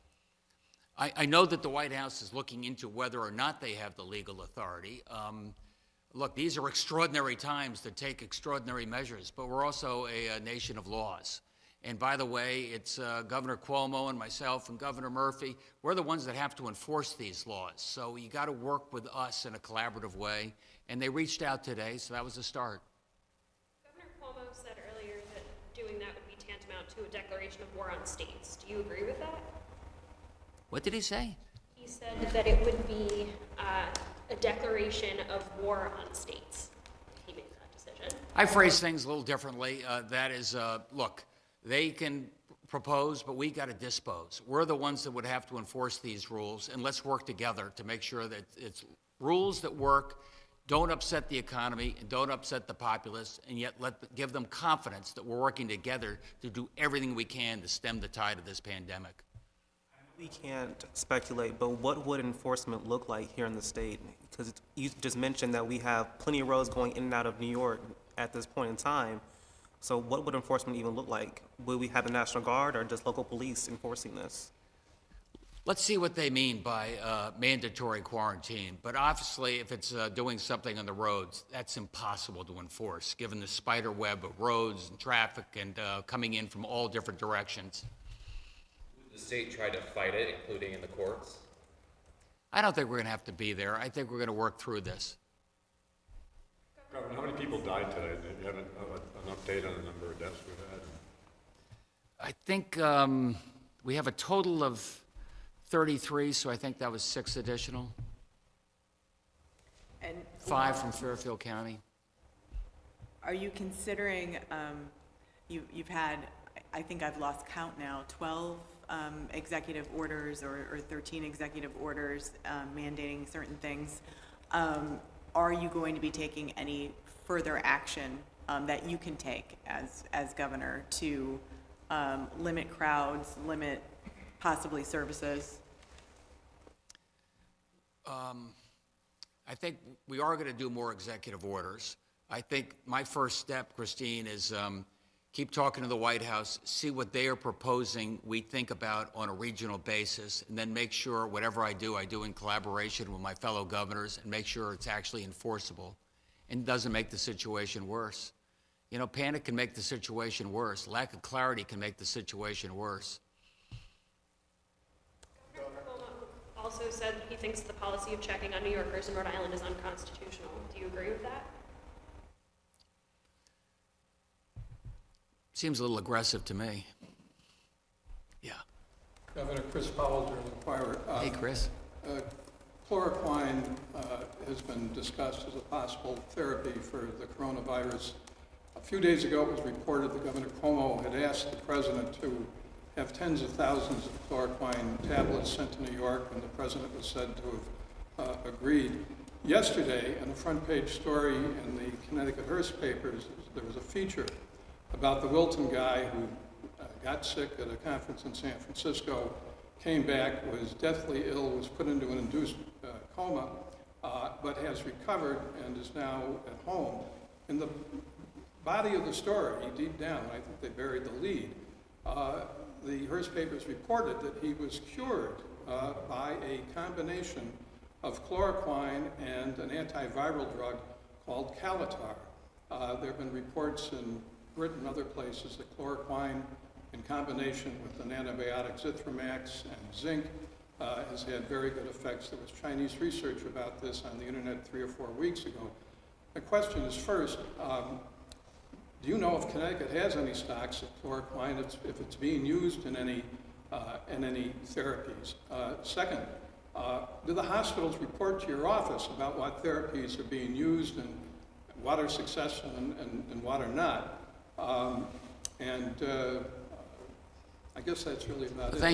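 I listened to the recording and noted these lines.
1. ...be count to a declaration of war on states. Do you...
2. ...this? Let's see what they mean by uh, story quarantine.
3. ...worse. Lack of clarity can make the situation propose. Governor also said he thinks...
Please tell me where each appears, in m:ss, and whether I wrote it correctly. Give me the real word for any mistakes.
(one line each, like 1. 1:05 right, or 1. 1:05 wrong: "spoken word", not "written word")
1. 0:26 wrong: "tantamount", not "count"
2. 1:14 wrong: "mandatory", not "story"
3. 2:40 wrong: "worse", not "propose".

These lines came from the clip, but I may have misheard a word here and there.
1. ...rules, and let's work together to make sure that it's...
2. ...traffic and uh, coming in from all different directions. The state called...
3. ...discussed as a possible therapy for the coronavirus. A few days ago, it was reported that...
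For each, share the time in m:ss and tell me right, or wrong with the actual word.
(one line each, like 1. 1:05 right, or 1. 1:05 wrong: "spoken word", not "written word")
1. 0:46 right
2. 1:24 wrong: "tried", not "called"
3. 3:04 right.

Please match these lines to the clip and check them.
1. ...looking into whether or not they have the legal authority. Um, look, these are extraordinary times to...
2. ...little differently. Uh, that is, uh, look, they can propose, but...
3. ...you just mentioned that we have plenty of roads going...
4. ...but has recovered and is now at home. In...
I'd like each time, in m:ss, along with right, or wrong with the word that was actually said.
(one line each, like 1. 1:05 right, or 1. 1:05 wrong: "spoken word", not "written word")
1. 0:02 right
2. 0:39 right
3. 1:04 right
4. 3:34 right.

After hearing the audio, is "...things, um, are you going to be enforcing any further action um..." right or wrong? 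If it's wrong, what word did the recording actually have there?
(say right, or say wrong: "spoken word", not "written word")
wrong: "taking", not "enforcing".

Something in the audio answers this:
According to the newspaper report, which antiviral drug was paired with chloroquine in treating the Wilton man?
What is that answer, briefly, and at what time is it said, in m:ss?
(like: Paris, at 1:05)
Kaletra, at 3:51.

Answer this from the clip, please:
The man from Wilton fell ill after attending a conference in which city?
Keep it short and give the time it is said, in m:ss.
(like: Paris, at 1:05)
San Francisco, at 3:28.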